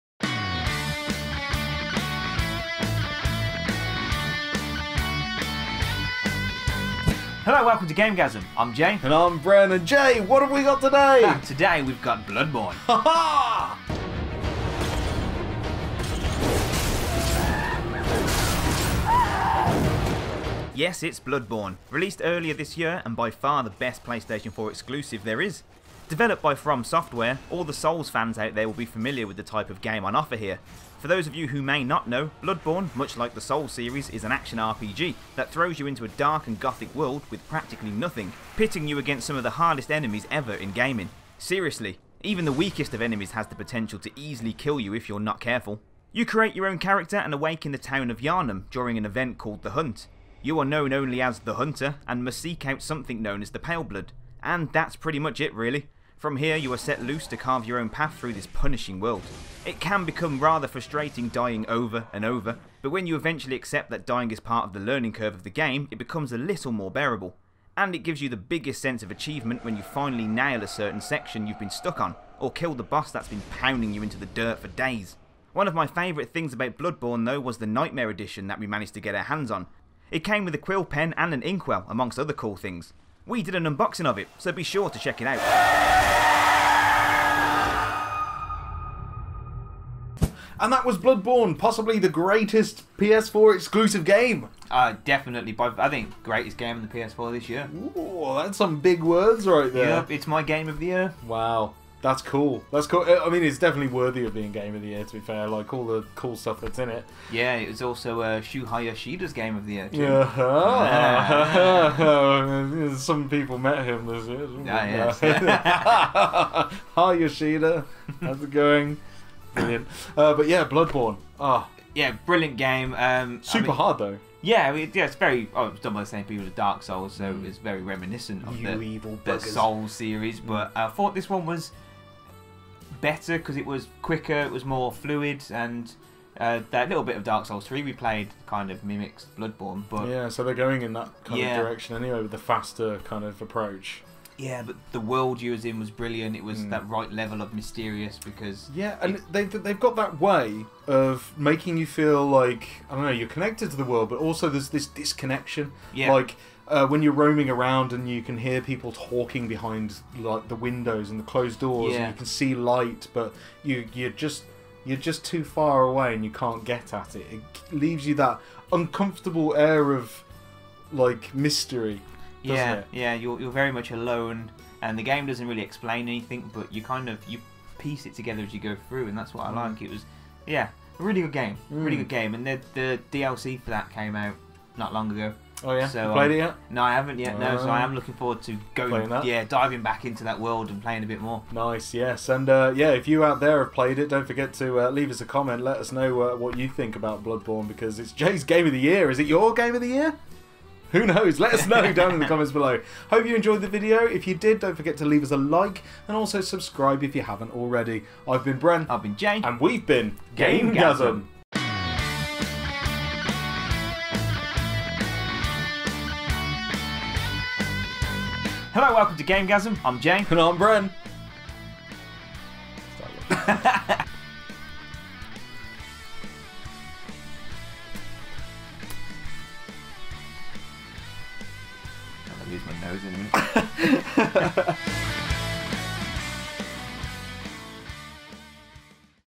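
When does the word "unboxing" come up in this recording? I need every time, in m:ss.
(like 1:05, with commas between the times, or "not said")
1:23.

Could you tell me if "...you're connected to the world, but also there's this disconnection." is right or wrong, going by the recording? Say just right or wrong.
right.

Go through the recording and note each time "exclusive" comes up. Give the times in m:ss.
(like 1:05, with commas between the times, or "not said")
0:24, 1:33.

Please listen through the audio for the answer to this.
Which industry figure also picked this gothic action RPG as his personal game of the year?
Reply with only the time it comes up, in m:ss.
1:48.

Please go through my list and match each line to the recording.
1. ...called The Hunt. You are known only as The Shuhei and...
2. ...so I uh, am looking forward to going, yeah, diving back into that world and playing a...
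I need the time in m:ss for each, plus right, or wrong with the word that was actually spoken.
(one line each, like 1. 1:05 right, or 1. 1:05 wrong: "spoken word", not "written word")
1. 0:49 wrong: "Hunter", not "Shuhei"
2. 3:07 right.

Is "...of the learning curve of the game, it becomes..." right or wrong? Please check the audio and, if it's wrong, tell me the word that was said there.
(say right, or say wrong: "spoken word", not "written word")
right.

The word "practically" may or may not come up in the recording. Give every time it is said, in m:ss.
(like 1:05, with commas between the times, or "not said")
0:37.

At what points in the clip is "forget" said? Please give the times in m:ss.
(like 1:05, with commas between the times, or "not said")
3:14, 3:24.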